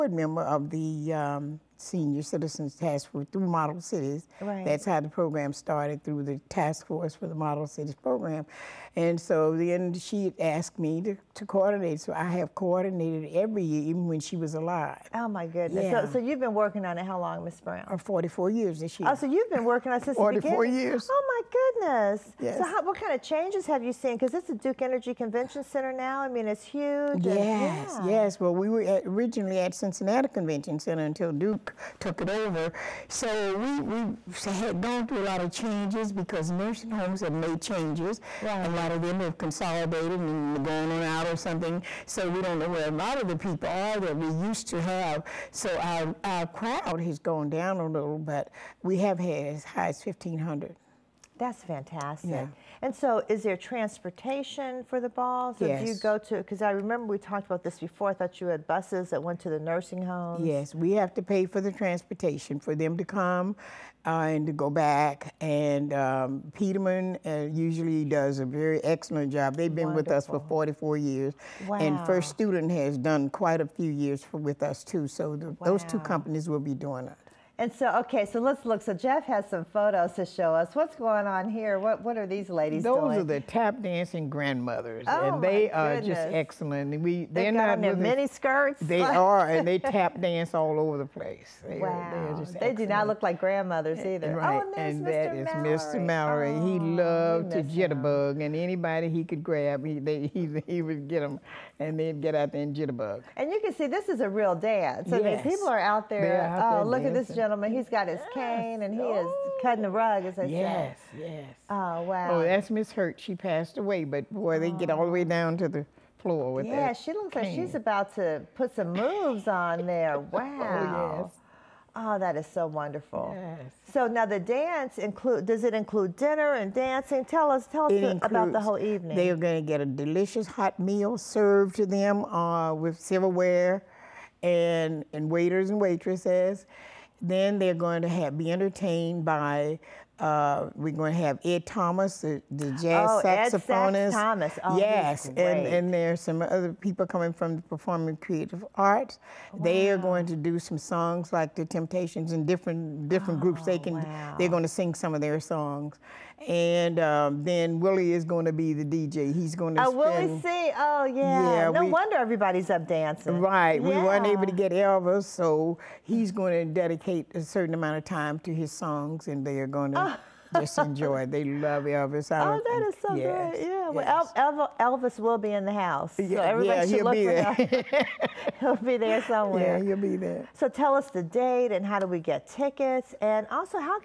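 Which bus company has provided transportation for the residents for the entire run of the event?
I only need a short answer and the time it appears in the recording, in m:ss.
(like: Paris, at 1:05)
Peterman, at 1:06.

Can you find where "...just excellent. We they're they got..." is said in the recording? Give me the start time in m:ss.
1:25.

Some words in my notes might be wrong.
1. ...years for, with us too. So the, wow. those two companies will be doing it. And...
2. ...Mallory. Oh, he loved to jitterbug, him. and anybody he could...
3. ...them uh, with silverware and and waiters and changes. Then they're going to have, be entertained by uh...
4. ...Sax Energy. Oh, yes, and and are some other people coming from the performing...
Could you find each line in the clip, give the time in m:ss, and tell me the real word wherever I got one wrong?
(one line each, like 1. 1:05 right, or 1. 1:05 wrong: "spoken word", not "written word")
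1. 1:13 right
2. 1:36 right
3. 2:11 wrong: "waitresses", not "changes"
4. 2:24 wrong: "Thomas", not "Energy".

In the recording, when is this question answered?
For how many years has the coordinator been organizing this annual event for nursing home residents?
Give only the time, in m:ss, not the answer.
0:17.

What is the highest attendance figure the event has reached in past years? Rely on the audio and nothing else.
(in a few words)
1,500.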